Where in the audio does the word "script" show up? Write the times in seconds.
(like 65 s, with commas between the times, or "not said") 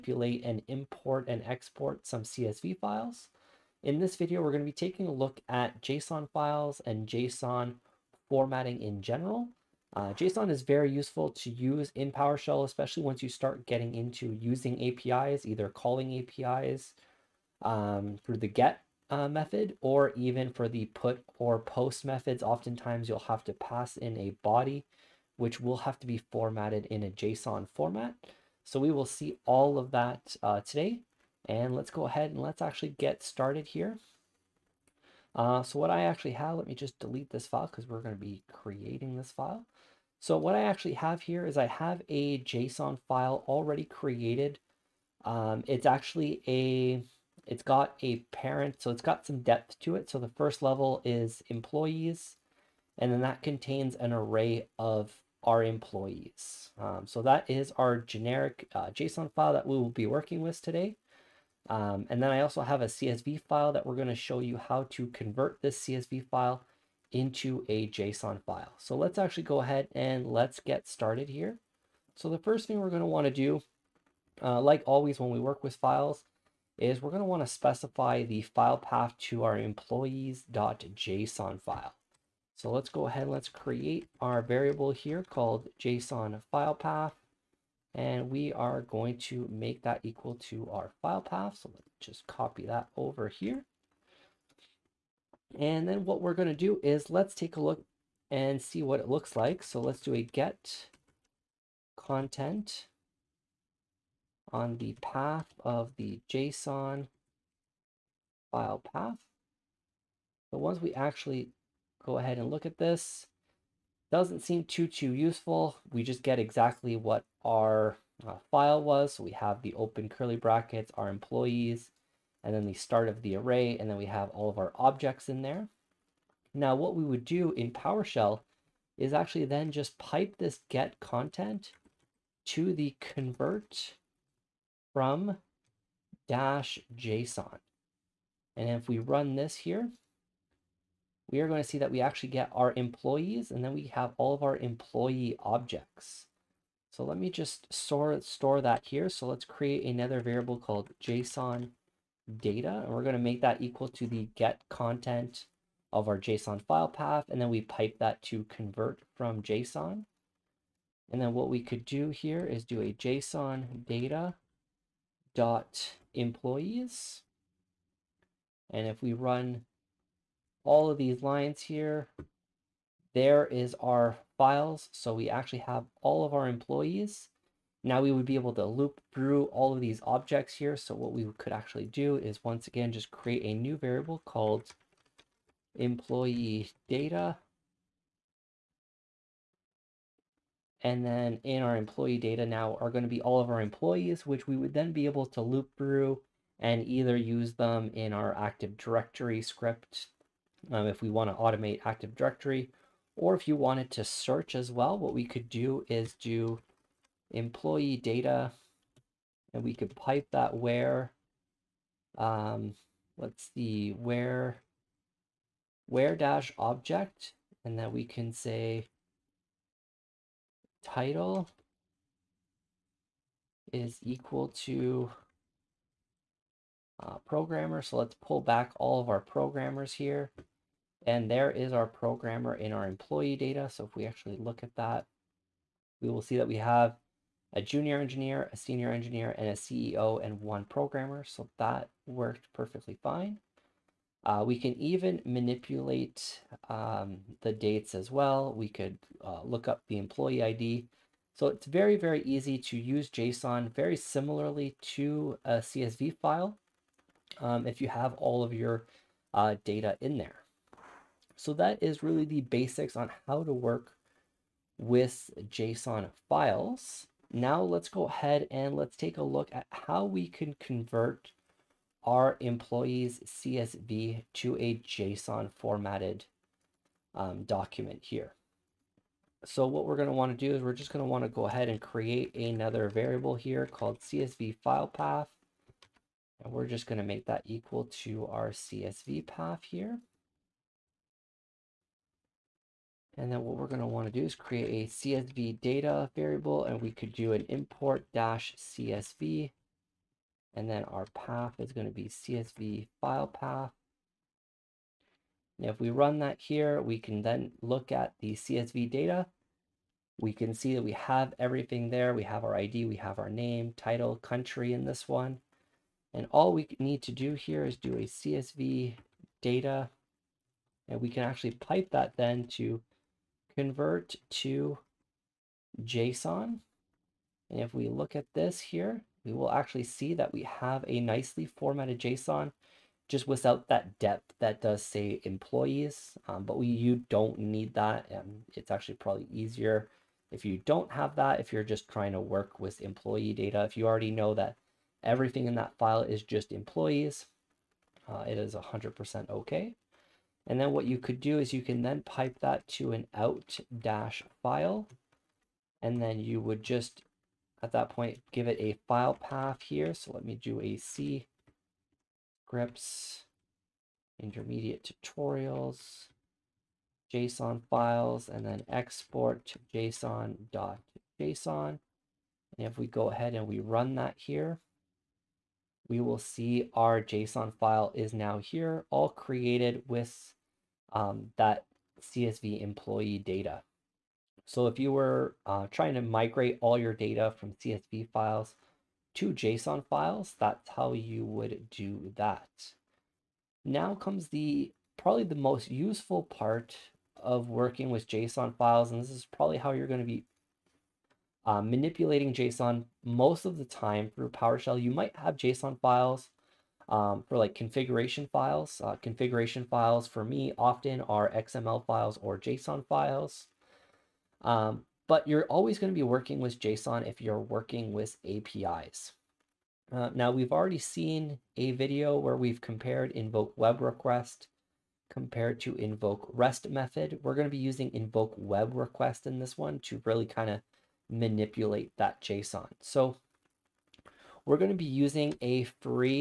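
199 s, 362 s.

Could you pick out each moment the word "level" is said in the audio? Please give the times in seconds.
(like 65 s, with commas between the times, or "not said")
50 s.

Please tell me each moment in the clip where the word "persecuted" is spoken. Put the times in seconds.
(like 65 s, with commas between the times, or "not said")
not said.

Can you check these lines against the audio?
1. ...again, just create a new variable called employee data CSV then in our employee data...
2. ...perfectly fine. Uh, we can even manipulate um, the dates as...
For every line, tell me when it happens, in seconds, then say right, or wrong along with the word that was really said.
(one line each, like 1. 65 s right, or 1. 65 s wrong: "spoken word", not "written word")
1. 182 s wrong: "And", not "CSV"
2. 242 s right.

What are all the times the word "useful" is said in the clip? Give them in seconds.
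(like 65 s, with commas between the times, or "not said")
10 s, 115 s, 395 s.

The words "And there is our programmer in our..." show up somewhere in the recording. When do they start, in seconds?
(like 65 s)
231 s.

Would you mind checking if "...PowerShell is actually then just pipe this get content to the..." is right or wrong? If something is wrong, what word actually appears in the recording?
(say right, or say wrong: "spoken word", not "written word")
right.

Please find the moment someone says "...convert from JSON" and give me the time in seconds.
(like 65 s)
158 s.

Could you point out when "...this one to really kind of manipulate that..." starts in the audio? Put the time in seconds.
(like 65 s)
429 s.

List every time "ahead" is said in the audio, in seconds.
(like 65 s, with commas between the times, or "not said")
32 s, 69 s, 83 s, 112 s, 268 s, 281 s, 373 s.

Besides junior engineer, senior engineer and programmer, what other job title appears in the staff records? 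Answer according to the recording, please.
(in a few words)
CEO.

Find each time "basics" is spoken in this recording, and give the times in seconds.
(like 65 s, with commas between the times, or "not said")
262 s.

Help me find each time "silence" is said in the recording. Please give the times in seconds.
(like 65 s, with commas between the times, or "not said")
not said.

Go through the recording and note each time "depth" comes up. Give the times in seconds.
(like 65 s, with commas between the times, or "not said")
49 s, 333 s.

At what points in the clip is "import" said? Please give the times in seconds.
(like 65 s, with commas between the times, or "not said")
0 s, 297 s.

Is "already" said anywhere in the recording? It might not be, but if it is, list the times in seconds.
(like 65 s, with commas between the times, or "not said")
43 s, 343 s, 420 s.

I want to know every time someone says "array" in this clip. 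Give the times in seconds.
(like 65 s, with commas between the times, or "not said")
54 s, 123 s.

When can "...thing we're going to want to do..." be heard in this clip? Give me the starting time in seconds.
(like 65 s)
72 s.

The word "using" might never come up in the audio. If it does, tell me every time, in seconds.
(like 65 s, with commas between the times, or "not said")
14 s, 427 s, 434 s.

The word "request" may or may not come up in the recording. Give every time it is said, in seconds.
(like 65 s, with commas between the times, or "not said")
423 s, 428 s.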